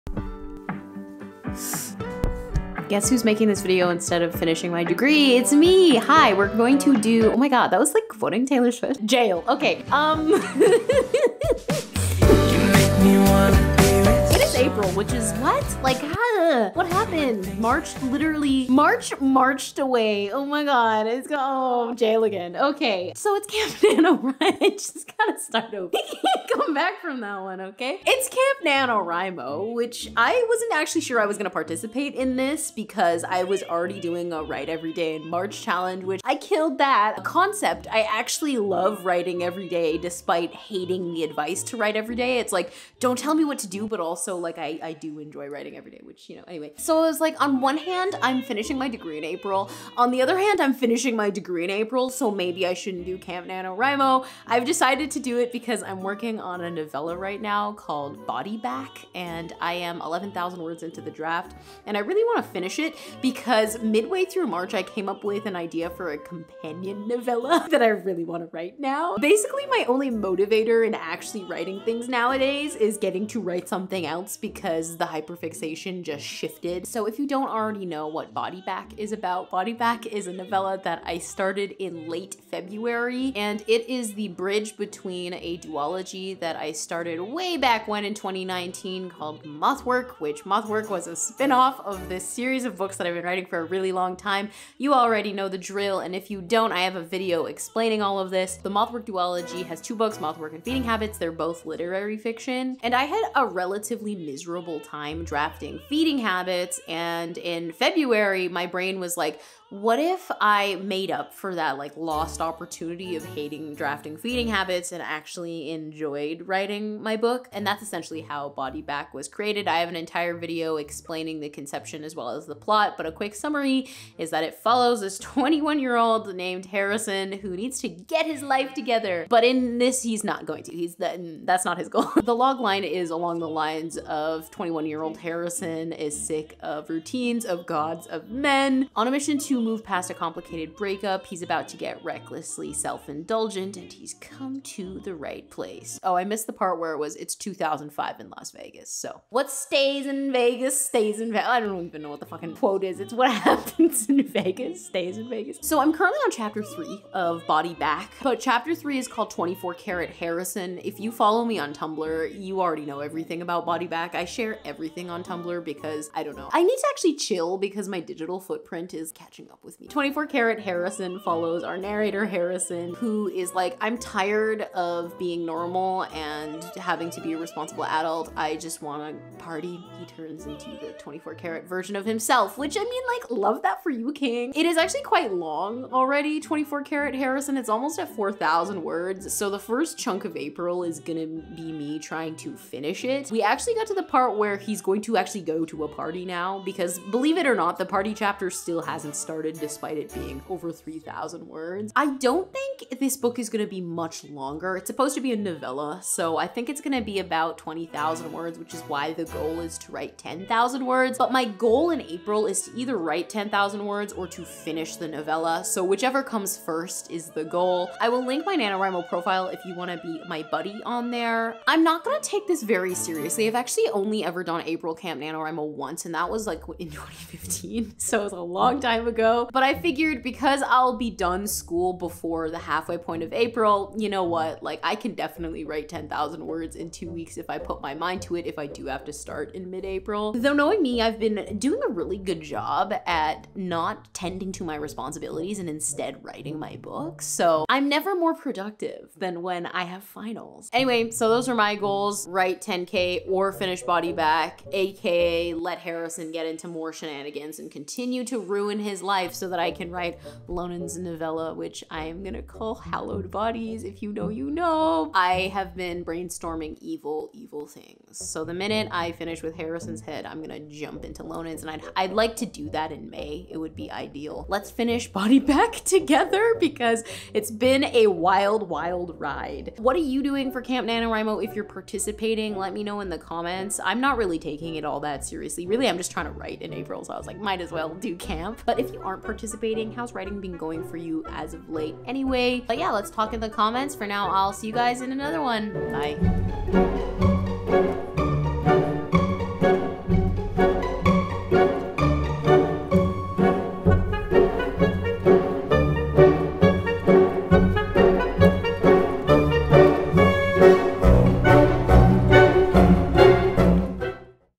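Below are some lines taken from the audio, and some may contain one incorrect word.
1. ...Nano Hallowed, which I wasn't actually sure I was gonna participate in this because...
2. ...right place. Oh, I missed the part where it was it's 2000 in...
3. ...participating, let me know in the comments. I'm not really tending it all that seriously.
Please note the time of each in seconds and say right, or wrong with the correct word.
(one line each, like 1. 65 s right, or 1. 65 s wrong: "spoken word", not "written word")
1. 28 s wrong: "NaNoWriMo", not "Hallowed"
2. 145 s wrong: "2005", not "2000"
3. 281 s wrong: "taking", not "tending".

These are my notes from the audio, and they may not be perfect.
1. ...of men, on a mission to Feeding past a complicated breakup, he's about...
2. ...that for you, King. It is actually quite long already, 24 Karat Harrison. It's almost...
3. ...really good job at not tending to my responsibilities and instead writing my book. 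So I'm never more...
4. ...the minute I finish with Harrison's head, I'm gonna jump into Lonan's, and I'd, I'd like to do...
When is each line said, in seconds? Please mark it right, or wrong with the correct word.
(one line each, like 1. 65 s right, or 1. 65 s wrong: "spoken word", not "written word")
1. 138 s wrong: "Move", not "Feeding"
2. 183 s right
3. 241 s right
4. 268 s right.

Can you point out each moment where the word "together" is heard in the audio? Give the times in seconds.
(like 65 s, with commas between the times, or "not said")
128 s, 275 s.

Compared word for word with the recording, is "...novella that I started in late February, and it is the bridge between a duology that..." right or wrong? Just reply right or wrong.
right.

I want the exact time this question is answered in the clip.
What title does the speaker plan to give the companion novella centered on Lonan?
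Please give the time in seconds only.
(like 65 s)
262 s.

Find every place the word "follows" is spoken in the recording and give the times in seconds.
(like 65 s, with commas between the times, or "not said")
124 s, 161 s, 171 s.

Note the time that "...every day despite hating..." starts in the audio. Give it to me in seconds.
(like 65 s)
39 s.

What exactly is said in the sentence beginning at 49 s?
On the other hand, I'm finishing my degree in April, so maybe I shouldn't do Camp NaNoWriMo.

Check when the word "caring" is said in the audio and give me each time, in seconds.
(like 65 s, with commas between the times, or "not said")
not said.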